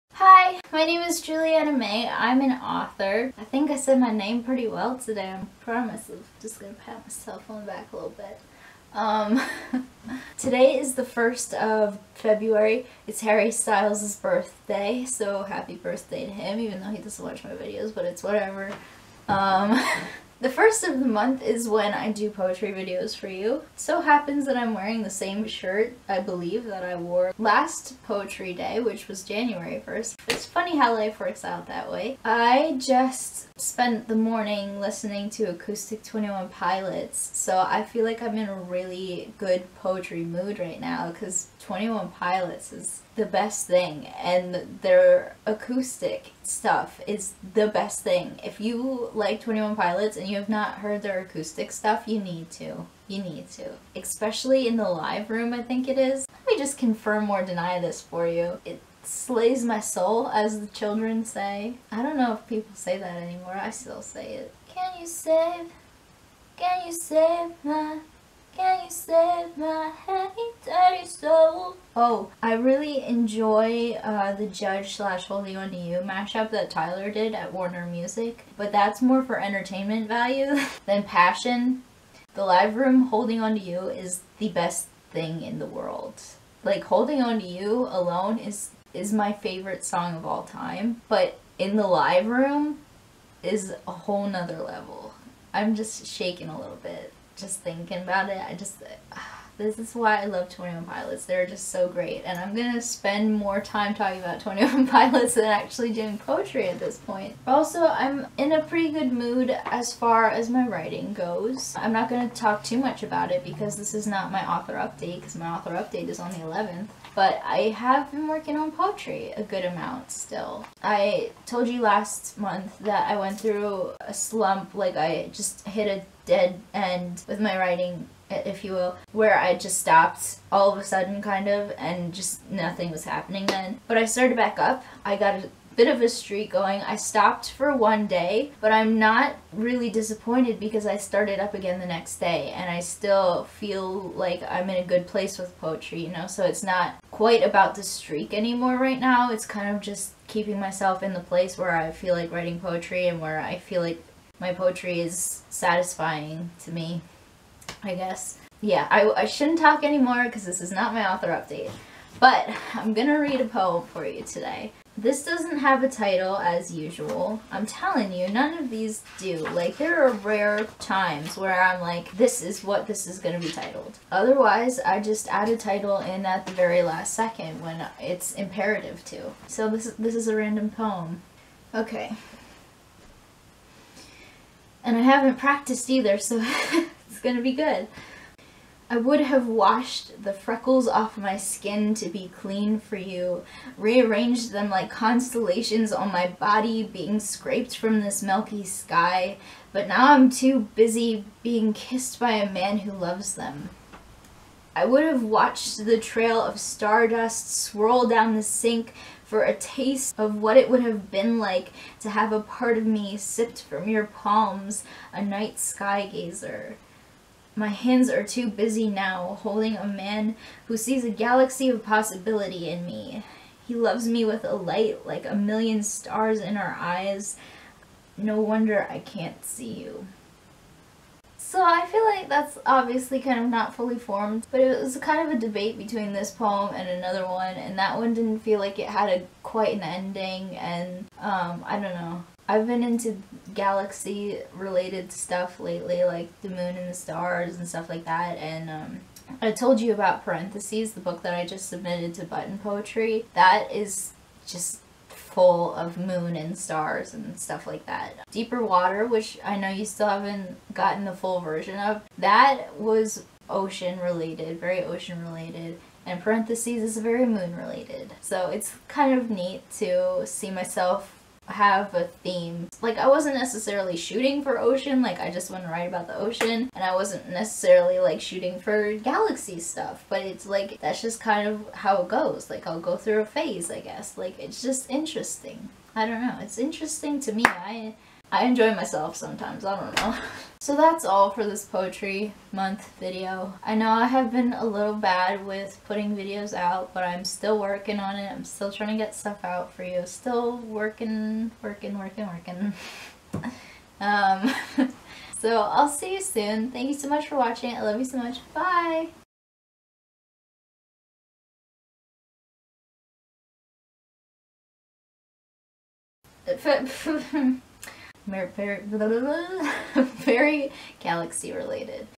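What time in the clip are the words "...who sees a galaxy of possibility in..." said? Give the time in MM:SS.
03:40.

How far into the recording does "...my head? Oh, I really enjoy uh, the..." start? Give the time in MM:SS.
01:09.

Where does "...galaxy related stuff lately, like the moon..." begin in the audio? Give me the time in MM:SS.
04:03.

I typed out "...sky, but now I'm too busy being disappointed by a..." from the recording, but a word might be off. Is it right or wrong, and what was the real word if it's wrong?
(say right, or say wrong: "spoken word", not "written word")
wrong: "kissed", not "disappointed".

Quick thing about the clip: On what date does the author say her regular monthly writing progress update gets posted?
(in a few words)
11th.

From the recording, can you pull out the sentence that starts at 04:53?
I know I have been a little bad with putting videos out, but I'm still working on it.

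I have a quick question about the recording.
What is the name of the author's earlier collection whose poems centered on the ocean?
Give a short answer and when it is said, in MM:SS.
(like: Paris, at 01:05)
Deeper Water, at 04:18.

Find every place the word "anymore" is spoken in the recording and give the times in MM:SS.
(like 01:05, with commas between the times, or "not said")
01:03, 02:28, 02:39.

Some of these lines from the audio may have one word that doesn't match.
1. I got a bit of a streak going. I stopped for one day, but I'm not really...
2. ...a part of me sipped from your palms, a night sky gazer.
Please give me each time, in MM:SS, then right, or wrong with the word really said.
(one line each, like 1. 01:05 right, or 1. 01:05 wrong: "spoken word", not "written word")
1. 02:15 right
2. 03:32 right.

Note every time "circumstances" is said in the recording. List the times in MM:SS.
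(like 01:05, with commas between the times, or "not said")
not said.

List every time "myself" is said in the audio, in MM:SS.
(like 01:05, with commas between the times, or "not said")
00:07, 02:30, 04:30, 04:48.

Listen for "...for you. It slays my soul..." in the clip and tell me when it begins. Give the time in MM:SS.
00:58.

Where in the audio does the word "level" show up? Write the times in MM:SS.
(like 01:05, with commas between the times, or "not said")
01:34.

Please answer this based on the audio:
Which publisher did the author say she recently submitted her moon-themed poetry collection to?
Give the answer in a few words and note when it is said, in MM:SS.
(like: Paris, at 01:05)
Button Poetry, at 04:12.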